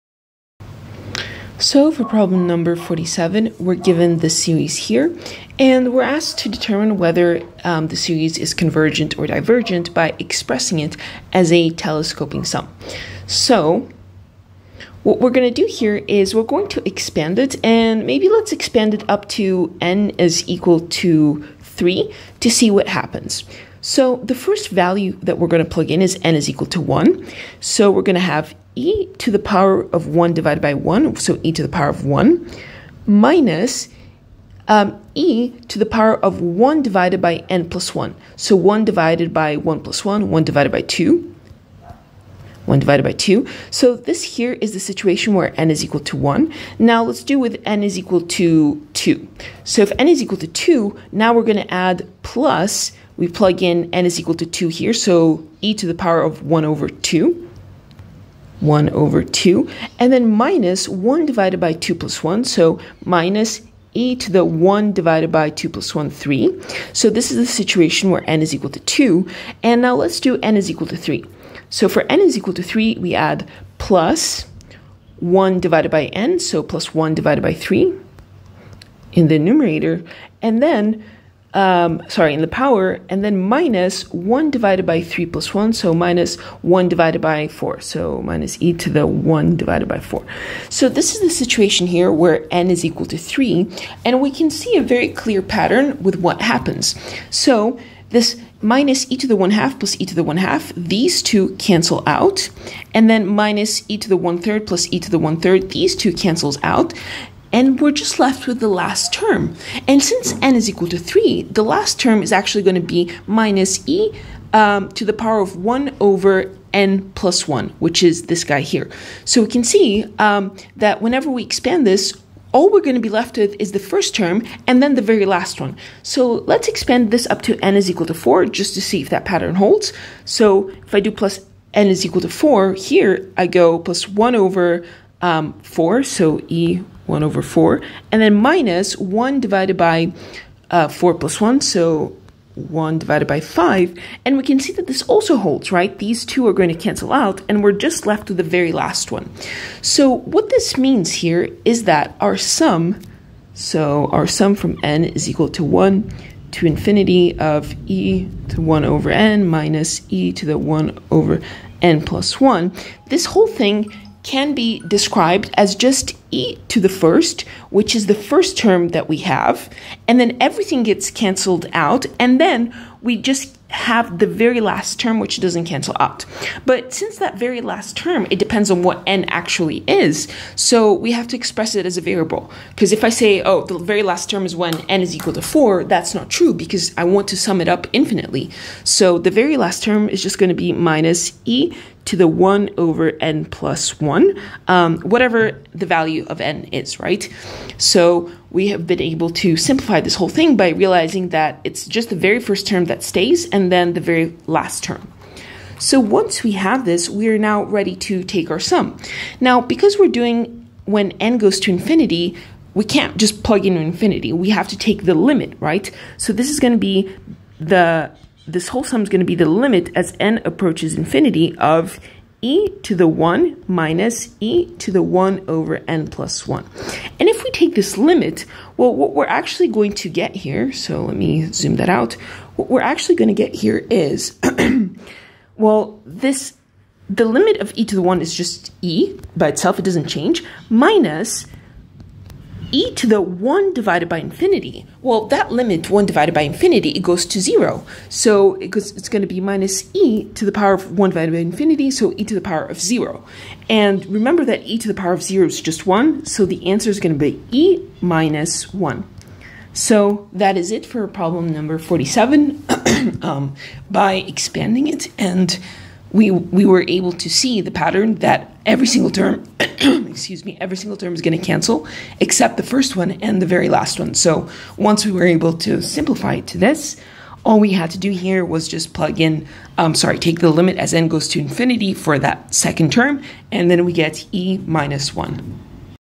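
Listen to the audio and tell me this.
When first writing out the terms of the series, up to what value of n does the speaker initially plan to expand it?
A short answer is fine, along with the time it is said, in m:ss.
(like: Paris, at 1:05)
3, at 0:19.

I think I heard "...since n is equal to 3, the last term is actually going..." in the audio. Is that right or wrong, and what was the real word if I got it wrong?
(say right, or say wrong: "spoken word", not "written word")
right.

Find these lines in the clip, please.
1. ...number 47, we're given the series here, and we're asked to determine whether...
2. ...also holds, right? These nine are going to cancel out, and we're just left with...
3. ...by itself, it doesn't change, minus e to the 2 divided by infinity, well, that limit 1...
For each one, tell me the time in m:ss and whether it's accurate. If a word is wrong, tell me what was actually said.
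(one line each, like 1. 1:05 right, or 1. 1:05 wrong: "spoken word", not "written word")
1. 0:02 right
2. 2:25 wrong: "two", not "nine"
3. 3:59 wrong: "1", not "2".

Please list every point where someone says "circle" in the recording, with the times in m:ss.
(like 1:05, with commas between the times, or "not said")
not said.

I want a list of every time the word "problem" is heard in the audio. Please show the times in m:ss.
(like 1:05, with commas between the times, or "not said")
0:02, 4:21.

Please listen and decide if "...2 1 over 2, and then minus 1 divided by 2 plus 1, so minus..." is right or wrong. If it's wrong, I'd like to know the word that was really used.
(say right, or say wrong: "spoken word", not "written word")
right.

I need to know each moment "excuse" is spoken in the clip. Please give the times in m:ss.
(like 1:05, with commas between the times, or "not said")
4:29.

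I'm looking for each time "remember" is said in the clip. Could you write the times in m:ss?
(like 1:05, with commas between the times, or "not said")
4:14.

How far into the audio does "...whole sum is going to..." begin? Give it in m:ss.
3:38.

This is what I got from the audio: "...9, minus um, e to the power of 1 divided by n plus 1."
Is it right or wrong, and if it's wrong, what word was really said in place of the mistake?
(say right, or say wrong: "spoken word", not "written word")
wrong: "1", not "9".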